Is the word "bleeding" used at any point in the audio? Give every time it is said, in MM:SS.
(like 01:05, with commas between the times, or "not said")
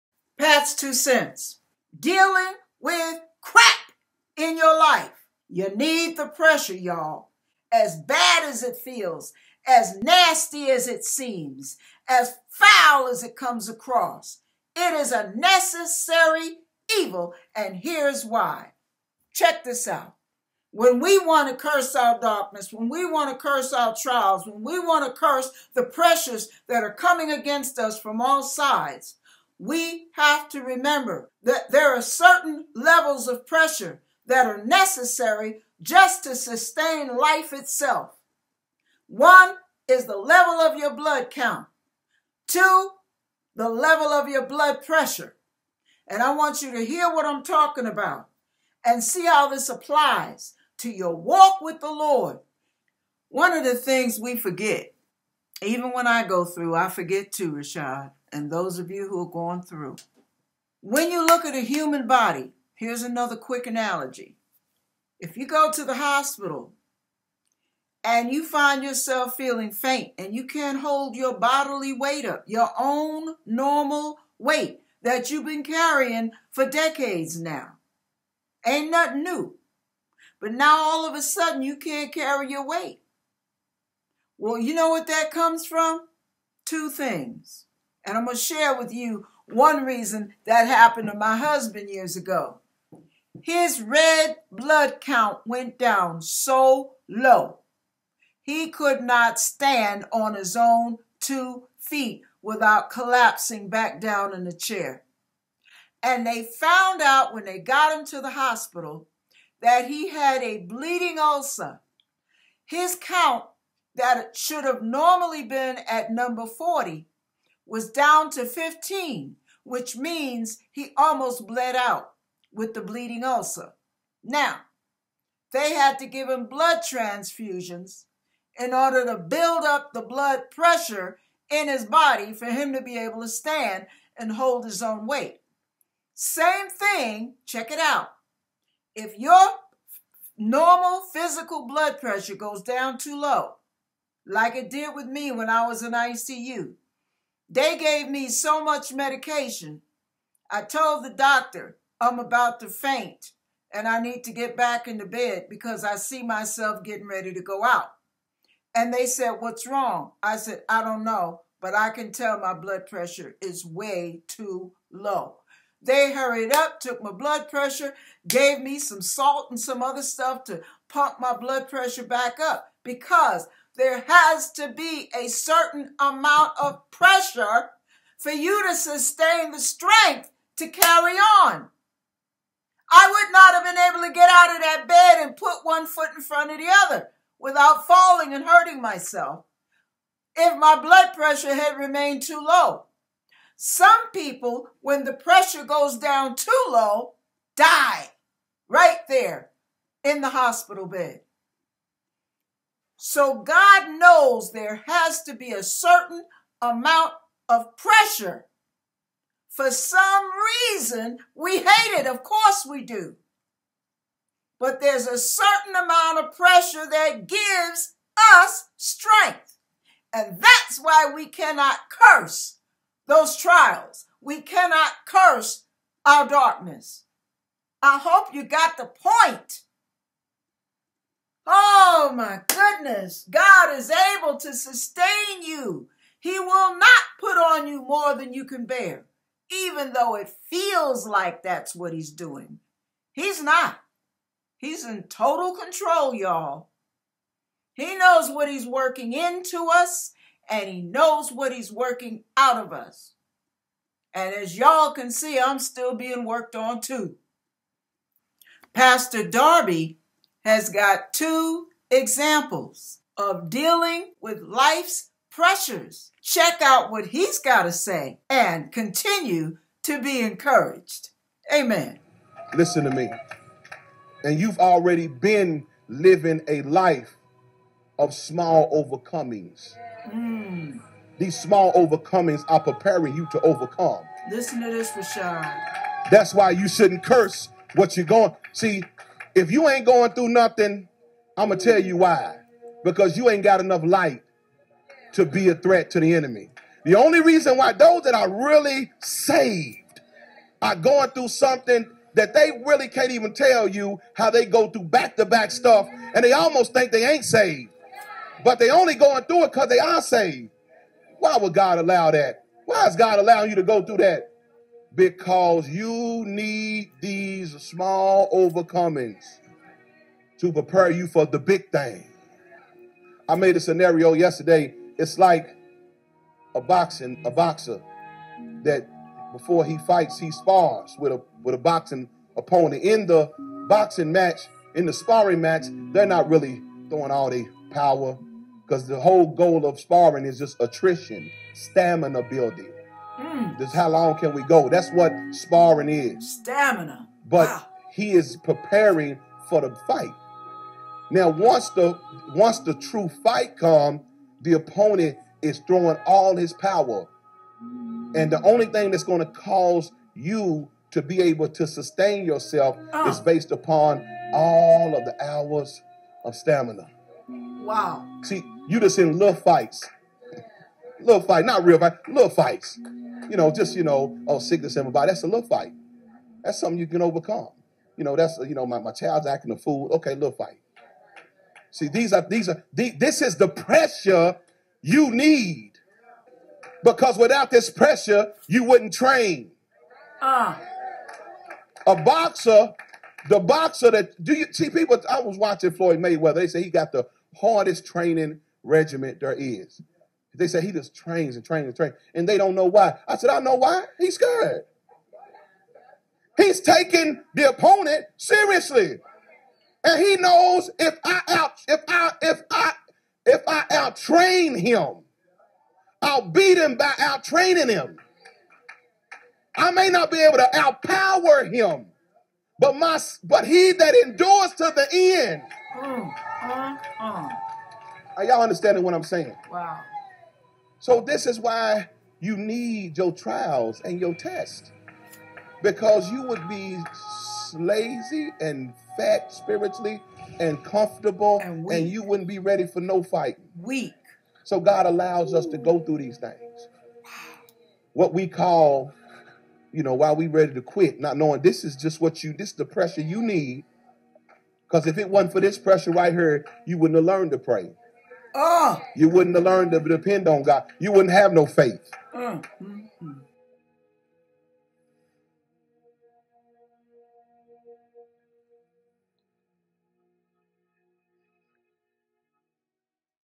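01:50, 02:02.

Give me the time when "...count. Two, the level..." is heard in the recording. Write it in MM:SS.
00:41.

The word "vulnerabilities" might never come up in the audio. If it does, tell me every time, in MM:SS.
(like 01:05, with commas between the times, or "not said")
not said.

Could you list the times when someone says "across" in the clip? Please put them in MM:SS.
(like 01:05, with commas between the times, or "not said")
00:13.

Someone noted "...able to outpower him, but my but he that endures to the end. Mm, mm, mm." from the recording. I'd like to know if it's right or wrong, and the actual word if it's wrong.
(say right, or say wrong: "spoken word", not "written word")
right.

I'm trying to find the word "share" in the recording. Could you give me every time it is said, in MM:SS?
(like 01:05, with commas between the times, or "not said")
01:28.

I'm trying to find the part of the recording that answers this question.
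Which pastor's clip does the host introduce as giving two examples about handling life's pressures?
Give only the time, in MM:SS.
04:18.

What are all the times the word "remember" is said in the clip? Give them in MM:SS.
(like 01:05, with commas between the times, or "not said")
00:30.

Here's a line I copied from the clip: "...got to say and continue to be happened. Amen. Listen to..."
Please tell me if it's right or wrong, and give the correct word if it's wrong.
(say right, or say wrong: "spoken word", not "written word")
wrong: "encouraged", not "happened".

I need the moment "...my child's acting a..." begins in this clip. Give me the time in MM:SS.
06:18.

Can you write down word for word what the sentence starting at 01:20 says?
But now all of a sudden you can't carry your weight.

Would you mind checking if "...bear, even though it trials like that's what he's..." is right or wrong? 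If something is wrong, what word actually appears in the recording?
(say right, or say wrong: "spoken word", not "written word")
wrong: "feels", not "trials".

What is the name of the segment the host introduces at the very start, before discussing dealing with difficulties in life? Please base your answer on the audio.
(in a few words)
Pat's Two Cents.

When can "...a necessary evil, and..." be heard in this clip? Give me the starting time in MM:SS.
00:15.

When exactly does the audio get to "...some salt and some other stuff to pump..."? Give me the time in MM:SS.
02:48.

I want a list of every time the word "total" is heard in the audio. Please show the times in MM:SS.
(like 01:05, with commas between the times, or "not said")
04:05.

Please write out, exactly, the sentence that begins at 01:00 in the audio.
When you look at a human body, here's another quick analogy.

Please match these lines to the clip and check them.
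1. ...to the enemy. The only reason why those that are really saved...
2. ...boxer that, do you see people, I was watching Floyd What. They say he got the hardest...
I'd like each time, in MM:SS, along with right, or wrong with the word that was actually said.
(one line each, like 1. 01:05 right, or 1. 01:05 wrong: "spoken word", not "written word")
1. 04:55 right
2. 06:33 wrong: "Mayweather", not "What".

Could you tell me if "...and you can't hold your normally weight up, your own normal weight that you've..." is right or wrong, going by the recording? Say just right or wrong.
wrong.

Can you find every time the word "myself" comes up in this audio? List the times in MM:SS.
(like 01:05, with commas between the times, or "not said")
02:36, 03:08.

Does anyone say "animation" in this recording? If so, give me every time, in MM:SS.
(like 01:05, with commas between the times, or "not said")
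not said.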